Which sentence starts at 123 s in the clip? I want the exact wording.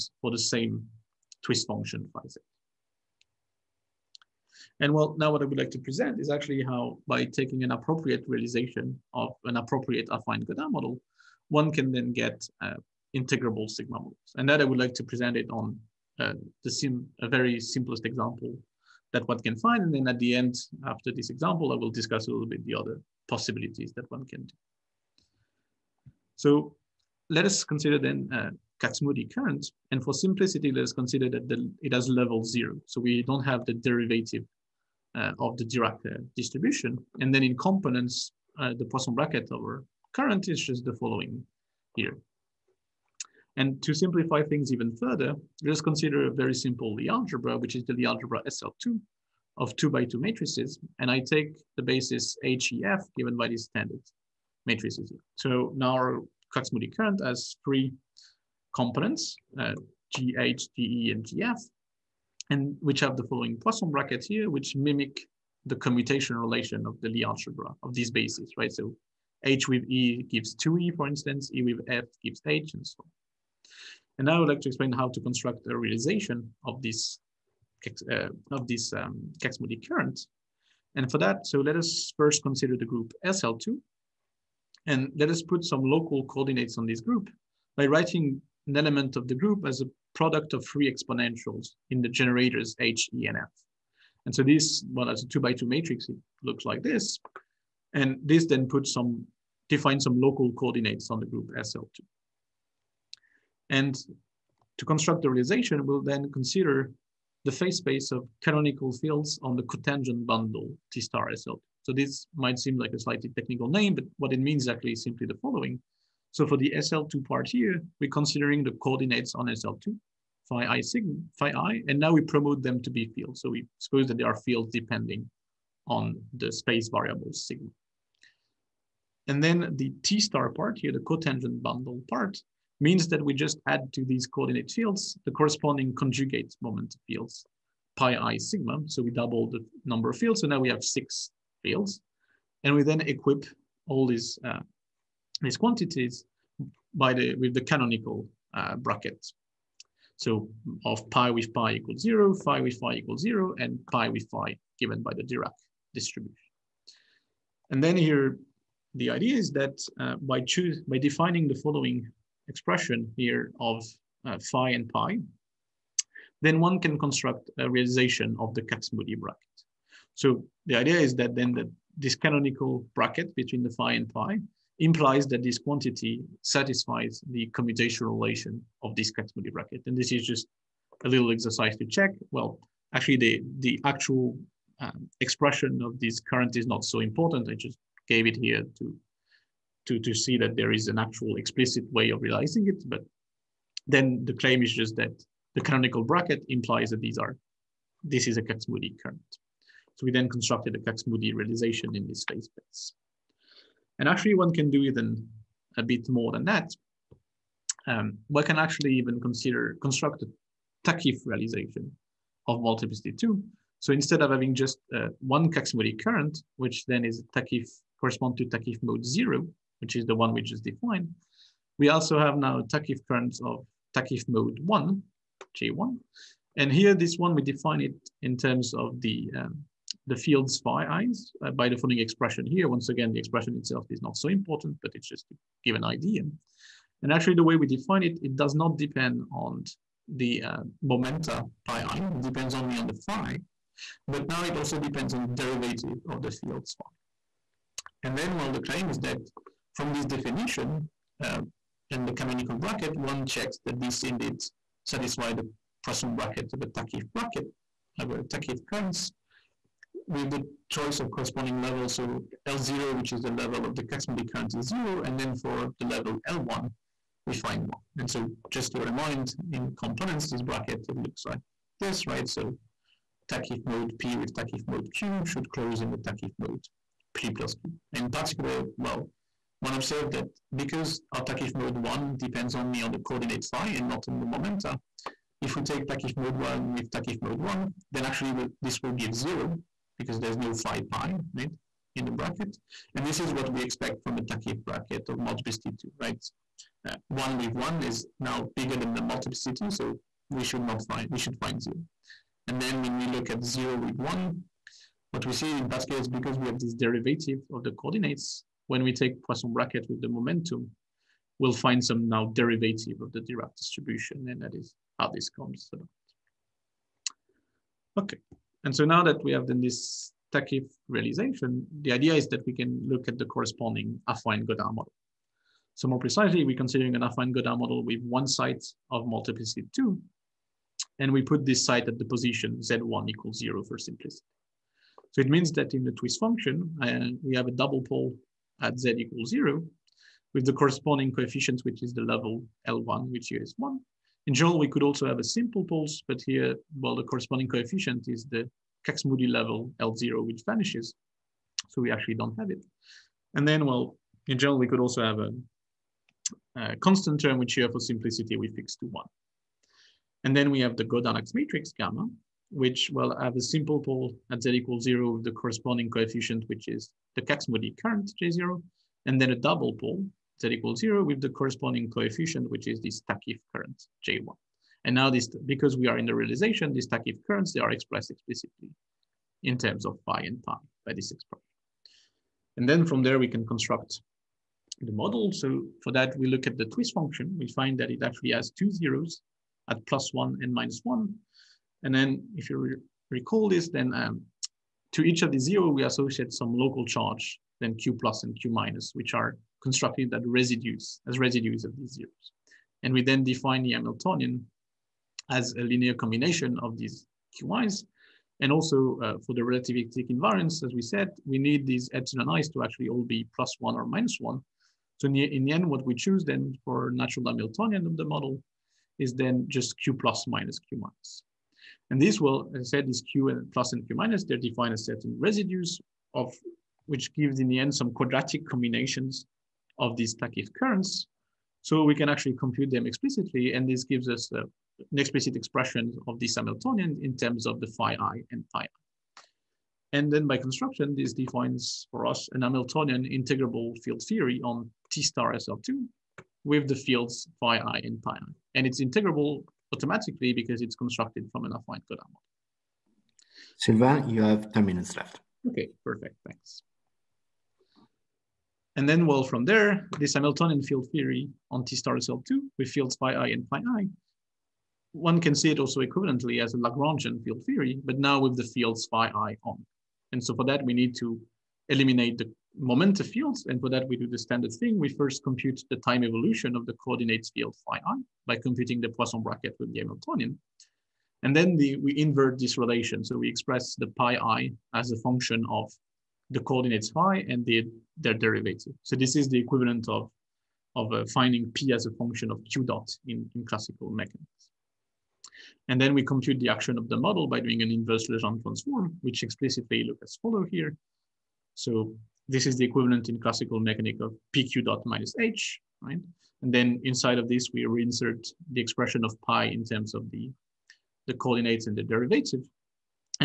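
So we suppose that they are fields depending on the space variable sigma.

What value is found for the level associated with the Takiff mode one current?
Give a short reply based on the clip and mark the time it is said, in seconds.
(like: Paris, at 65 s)
1, at 265 s.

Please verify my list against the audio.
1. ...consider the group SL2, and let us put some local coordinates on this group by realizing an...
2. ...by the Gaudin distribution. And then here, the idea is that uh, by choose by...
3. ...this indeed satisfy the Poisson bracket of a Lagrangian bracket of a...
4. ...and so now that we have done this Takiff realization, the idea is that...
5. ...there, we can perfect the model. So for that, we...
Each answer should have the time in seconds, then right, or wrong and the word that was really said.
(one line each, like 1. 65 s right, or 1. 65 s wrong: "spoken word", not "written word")
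1. 82 s wrong: "writing", not "realizing"
2. 155 s wrong: "Dirac", not "Gaudin"
3. 253 s wrong: "Takiff", not "Lagrangian"
4. 318 s right
5. 383 s wrong: "construct", not "perfect".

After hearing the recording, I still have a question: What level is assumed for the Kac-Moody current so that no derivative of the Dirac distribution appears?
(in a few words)
0.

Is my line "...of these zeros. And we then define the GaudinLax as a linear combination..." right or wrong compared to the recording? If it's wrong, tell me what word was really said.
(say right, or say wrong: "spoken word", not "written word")
wrong: "Hamiltonian", not "GaudinLax".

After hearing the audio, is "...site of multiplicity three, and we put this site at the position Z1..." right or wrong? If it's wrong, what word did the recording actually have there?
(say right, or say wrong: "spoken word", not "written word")
wrong: "two", not "three".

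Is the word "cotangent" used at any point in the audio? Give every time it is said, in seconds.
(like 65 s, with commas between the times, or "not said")
109 s, 130 s.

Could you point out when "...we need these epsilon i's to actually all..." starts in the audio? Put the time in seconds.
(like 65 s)
411 s.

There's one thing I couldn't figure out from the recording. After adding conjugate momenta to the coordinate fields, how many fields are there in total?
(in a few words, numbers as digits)
6.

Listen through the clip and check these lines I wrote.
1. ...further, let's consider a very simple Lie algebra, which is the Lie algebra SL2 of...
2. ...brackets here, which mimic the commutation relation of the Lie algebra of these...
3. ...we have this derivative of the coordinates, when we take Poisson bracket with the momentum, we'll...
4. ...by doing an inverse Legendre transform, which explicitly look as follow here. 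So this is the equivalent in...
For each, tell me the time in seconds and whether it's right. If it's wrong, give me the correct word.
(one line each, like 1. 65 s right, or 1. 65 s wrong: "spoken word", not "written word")
1. 44 s right
2. 63 s right
3. 306 s right
4. 497 s right.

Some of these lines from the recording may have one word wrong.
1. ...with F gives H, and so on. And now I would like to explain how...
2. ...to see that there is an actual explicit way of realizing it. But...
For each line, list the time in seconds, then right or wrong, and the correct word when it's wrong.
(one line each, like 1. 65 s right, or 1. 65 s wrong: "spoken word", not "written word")
1. 71 s right
2. 189 s right.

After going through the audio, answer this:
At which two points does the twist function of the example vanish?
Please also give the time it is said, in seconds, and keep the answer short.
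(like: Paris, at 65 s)
Plus one and minus one, at 389 s.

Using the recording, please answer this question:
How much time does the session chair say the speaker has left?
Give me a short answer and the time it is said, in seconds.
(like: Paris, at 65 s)
10 minutes, at 454 s.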